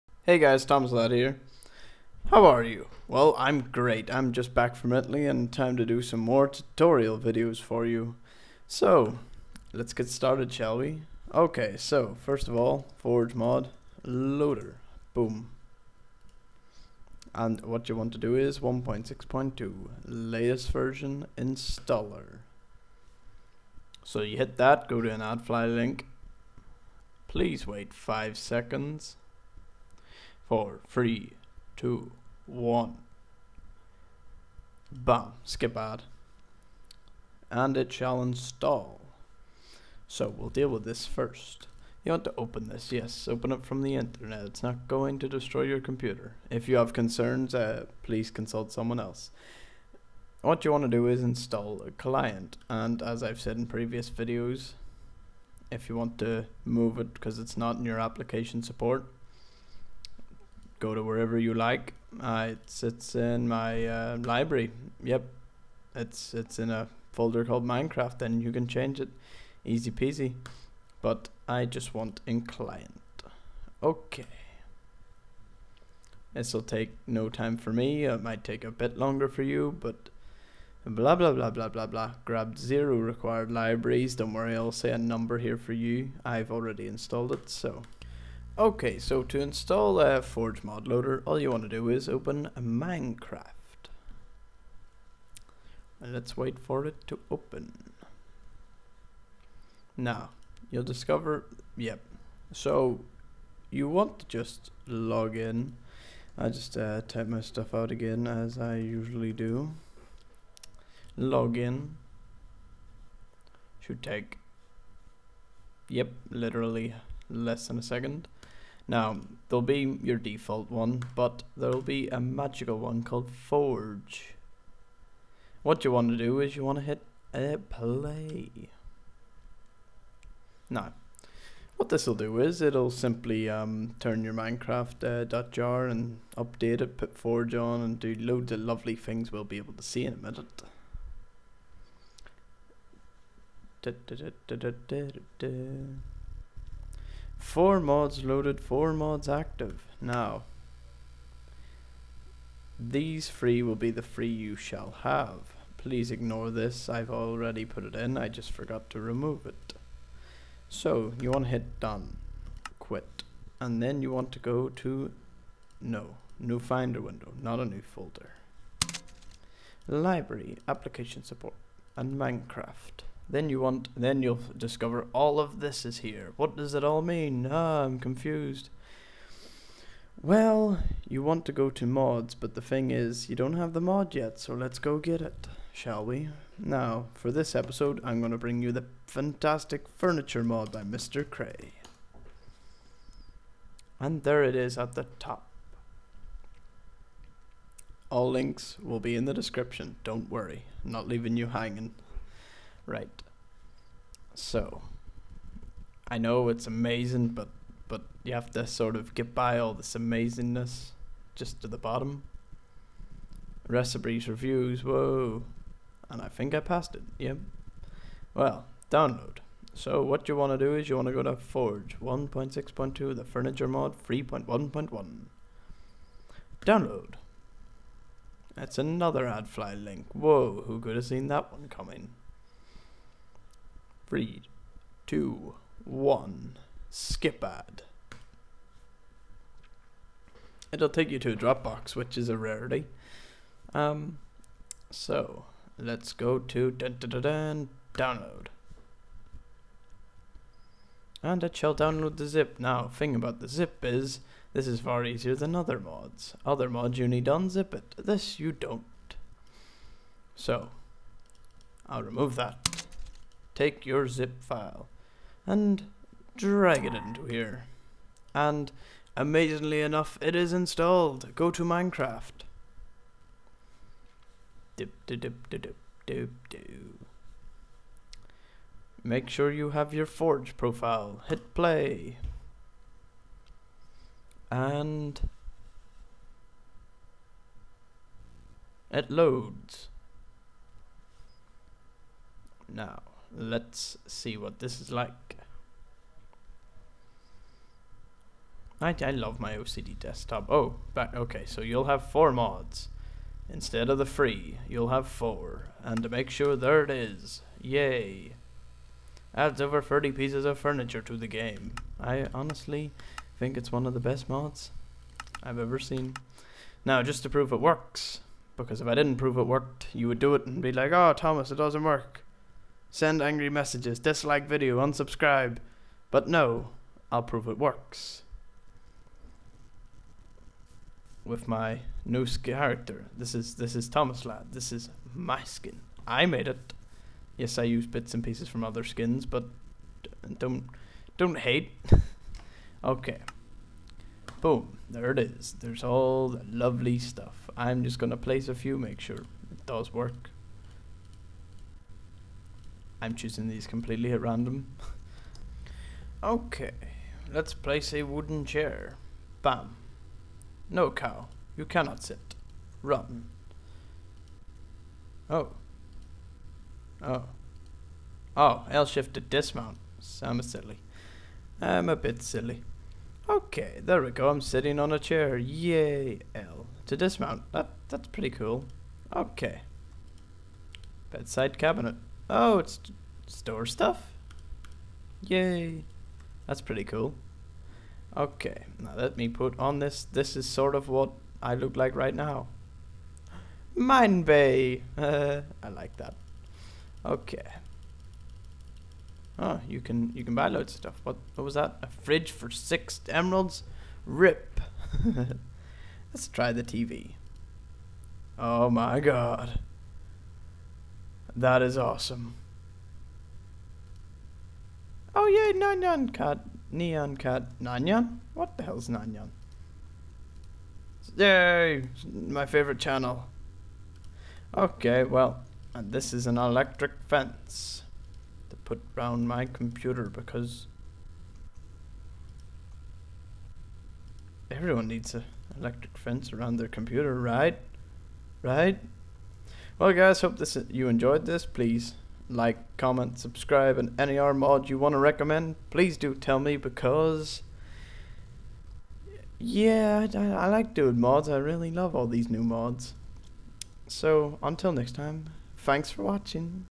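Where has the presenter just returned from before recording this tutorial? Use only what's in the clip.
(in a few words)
Italy.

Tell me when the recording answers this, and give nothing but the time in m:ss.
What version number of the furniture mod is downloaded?
3:44.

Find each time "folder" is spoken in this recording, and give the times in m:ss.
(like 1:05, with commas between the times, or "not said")
1:07, 2:47.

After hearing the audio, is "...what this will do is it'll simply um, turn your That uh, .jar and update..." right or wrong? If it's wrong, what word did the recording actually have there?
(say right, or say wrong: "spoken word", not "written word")
wrong: "Minecraft", not "That".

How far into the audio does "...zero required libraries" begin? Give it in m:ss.
1:22.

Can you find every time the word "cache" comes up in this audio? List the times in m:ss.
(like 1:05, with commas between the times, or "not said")
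not said.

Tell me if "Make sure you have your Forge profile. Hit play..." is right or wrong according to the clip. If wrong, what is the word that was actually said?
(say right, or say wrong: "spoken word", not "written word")
right.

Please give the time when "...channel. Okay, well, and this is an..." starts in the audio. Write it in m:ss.
7:02.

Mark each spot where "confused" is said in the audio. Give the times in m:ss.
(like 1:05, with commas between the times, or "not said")
2:57.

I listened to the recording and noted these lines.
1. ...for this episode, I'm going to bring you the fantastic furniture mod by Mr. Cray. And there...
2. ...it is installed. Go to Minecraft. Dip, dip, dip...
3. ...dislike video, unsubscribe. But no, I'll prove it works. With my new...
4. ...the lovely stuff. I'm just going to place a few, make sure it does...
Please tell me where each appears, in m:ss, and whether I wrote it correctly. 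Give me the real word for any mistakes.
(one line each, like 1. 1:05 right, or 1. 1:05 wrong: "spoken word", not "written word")
1. 3:07 right
2. 4:30 right
3. 5:23 right
4. 5:46 right.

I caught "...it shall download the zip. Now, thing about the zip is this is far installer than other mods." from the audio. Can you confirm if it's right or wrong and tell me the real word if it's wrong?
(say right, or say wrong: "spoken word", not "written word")
wrong: "easier", not "installer".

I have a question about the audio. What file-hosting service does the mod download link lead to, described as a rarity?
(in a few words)
Dropbox.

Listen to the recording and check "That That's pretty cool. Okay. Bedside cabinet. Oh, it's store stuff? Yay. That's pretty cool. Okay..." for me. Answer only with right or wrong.
right.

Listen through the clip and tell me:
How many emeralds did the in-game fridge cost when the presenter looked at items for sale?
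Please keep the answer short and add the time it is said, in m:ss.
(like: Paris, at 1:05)
6, at 6:42.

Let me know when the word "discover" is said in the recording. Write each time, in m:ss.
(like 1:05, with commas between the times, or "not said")
1:40, 2:54.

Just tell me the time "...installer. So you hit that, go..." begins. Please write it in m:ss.
0:21.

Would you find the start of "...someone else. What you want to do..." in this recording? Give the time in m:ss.
0:48.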